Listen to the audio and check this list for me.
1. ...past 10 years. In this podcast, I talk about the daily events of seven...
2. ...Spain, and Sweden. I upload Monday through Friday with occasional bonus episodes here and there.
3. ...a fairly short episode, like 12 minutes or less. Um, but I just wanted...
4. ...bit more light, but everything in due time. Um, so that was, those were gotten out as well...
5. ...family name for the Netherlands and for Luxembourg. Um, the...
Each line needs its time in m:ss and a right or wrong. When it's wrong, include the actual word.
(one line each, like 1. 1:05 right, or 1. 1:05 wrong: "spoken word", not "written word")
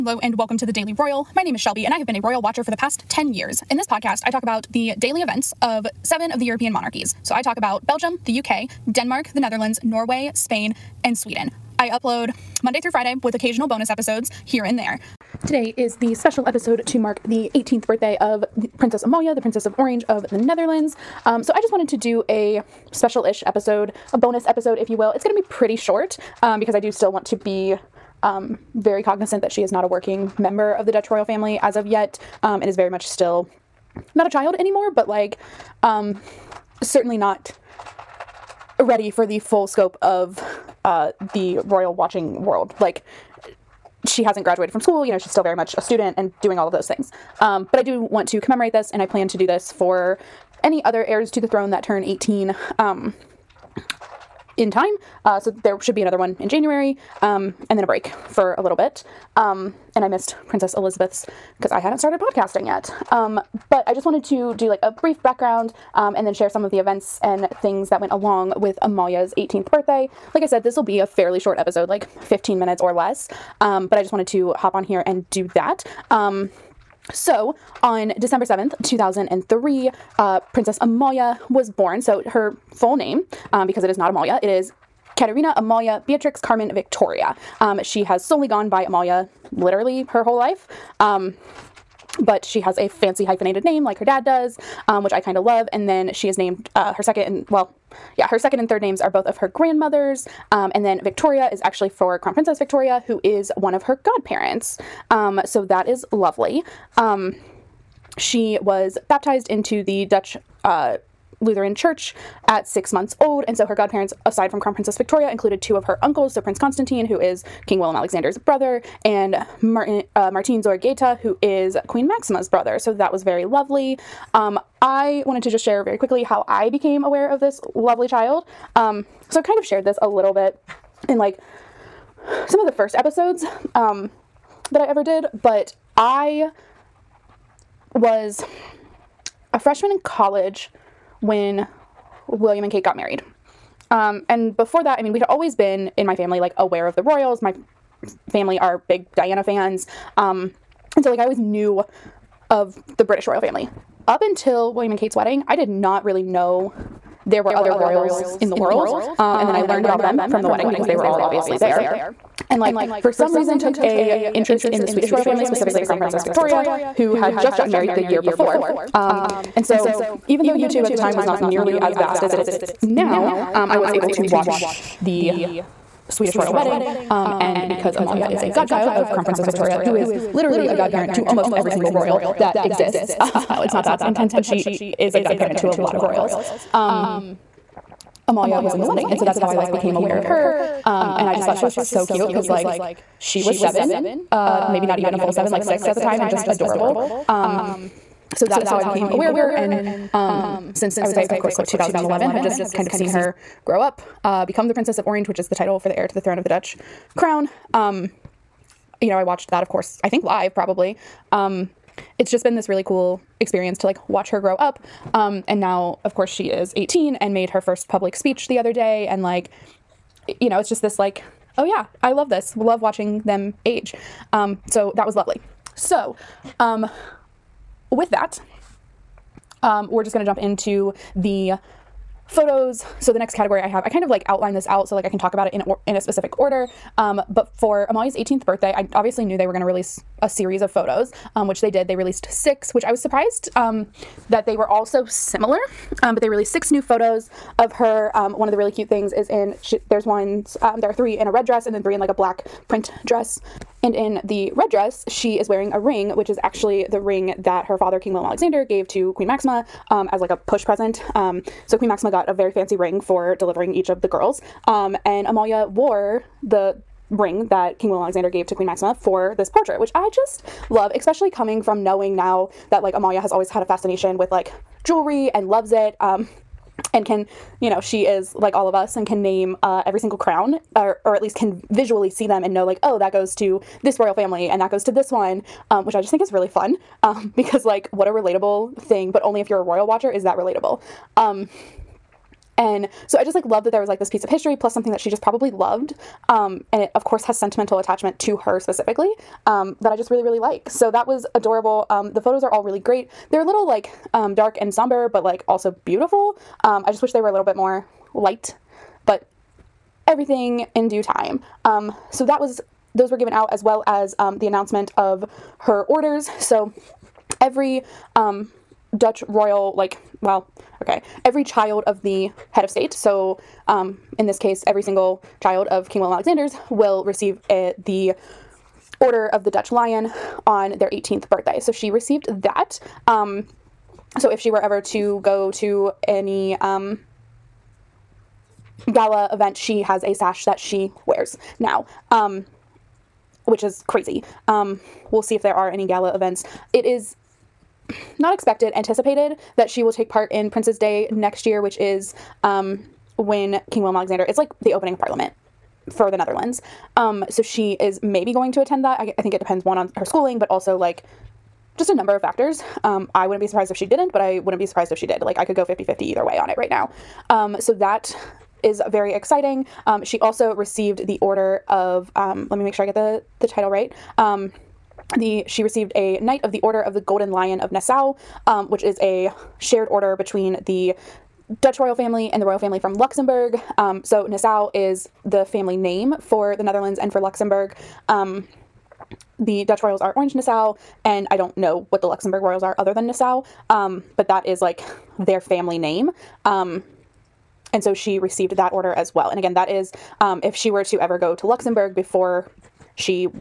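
1. 0:02 right
2. 0:10 right
3. 1:10 wrong: "15", not "12"
4. 5:07 wrong: "given", not "gotten"
5. 6:25 right.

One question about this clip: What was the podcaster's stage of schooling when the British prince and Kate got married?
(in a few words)
Freshman in college.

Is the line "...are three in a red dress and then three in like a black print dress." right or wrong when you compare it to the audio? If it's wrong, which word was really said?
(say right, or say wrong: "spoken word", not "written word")
right.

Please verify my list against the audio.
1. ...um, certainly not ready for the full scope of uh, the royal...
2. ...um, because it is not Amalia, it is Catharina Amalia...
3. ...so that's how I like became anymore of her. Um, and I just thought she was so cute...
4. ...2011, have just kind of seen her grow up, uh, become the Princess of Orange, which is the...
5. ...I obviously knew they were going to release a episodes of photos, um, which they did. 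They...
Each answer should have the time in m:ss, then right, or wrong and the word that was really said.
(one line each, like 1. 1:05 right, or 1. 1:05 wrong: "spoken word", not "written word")
1. 0:35 right
2. 1:23 right
3. 3:09 wrong: "aware", not "anymore"
4. 3:21 right
5. 3:58 wrong: "series", not "episodes".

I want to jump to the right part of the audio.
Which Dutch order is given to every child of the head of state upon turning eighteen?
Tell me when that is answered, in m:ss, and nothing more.
5:29.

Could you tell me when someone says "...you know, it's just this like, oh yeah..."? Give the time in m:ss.
3:40.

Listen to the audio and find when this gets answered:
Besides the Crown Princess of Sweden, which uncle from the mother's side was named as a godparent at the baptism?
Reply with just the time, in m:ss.
2:00.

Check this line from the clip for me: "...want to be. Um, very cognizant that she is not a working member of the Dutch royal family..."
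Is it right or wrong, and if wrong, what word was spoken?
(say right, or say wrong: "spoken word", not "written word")
right.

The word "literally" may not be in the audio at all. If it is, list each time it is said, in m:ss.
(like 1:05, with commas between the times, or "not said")
1:29, 3:00.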